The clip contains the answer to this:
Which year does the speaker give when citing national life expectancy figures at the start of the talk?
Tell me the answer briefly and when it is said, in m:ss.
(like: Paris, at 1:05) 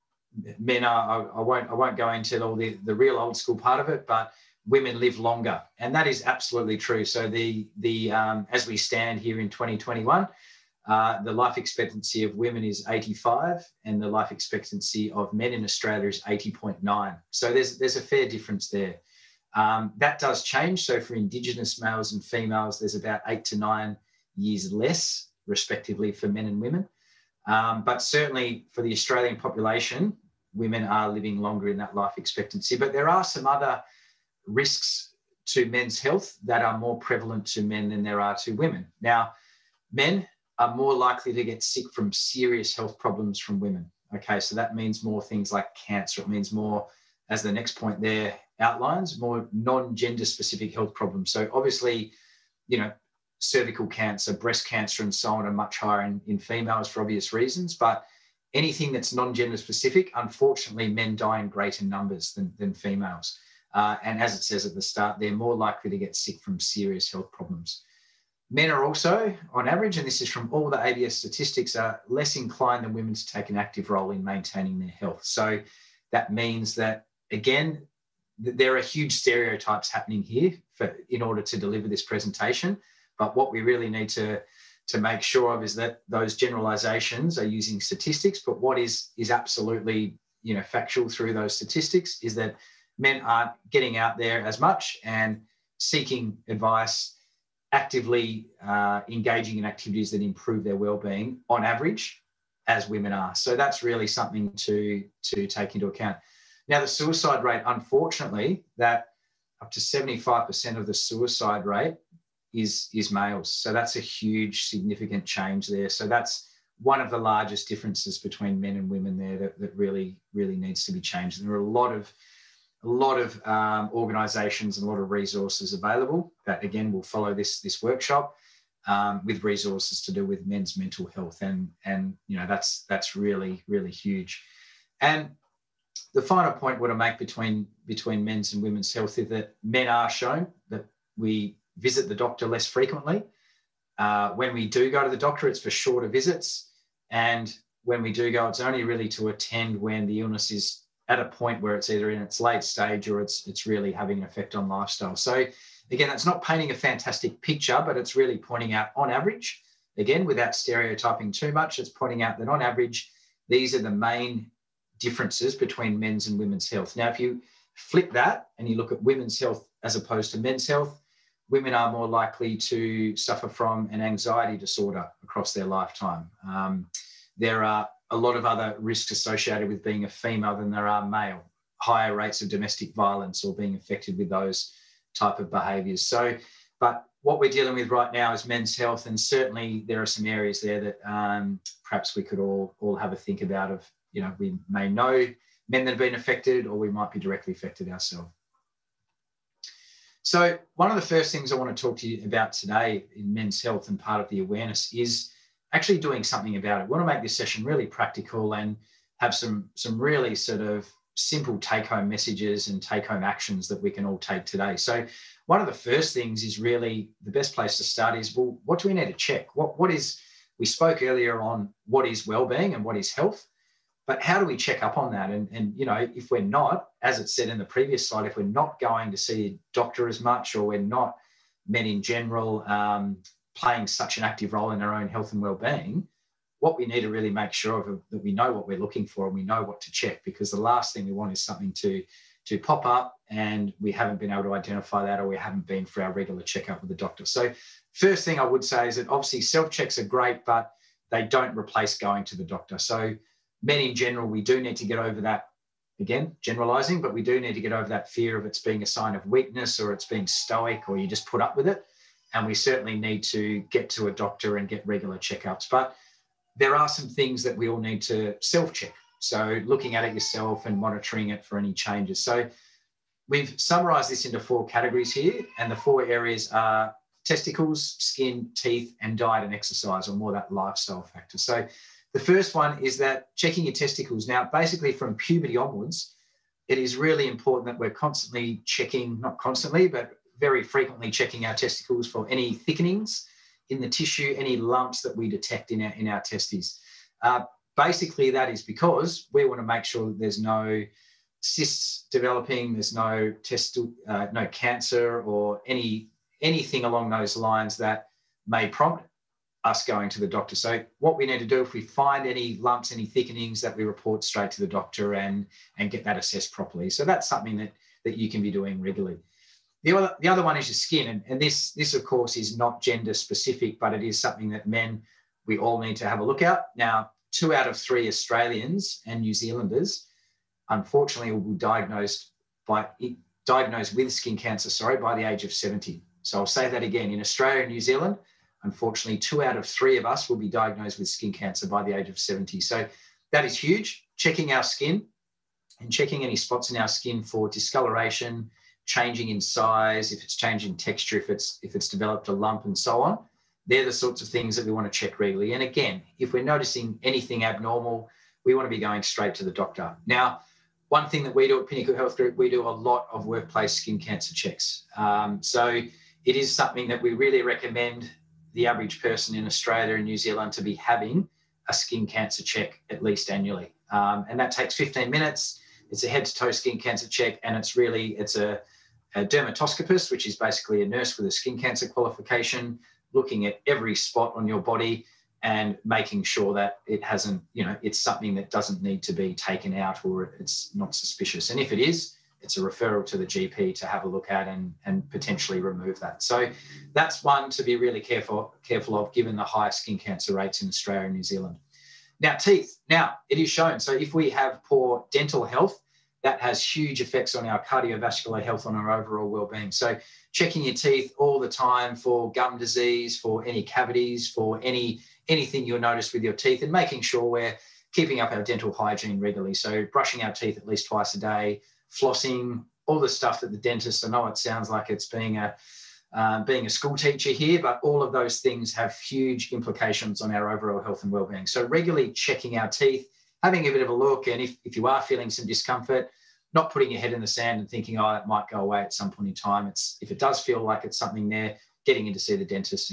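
2021, at 0:09.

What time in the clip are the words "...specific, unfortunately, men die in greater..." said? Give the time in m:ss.
0:59.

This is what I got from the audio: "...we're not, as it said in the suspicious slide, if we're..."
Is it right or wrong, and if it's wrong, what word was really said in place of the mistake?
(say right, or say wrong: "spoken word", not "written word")
wrong: "previous", not "suspicious".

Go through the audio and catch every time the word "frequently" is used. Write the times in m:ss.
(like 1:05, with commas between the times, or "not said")
2:22, 4:50.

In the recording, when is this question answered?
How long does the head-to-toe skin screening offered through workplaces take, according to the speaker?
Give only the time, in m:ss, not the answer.
6:14.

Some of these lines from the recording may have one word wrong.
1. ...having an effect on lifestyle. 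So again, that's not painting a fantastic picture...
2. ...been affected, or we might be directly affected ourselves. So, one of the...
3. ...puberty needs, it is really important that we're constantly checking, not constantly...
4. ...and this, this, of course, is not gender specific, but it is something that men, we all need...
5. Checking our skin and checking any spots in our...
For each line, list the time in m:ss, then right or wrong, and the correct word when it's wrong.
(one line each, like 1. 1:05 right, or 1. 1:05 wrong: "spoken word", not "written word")
1. 2:33 right
2. 3:15 right
3. 4:45 wrong: "onwards", not "needs"
4. 5:21 right
5. 5:44 right.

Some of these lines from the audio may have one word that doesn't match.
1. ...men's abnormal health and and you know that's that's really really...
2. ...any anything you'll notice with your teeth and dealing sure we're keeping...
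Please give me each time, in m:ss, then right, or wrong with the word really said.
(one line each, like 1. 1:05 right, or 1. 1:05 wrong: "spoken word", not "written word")
1. 2:10 wrong: "mental", not "abnormal"
2. 6:54 wrong: "making", not "dealing".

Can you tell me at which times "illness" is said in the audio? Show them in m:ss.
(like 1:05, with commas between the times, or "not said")
2:30.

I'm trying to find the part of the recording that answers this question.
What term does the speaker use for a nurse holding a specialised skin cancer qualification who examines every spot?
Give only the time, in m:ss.
6:19.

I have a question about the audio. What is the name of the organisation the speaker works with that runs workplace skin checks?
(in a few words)
Pinnacle Health Group.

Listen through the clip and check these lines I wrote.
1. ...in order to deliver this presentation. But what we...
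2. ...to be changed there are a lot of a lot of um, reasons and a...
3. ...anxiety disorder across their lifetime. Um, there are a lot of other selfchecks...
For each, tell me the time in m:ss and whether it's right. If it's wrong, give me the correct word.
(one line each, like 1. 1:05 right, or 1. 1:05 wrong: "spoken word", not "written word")
1. 1:21 right
2. 2:00 wrong: "organizations", not "reasons"
3. 2:54 wrong: "risks", not "selfchecks".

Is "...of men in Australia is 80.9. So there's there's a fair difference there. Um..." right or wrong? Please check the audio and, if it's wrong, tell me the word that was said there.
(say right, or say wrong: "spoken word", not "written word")
right.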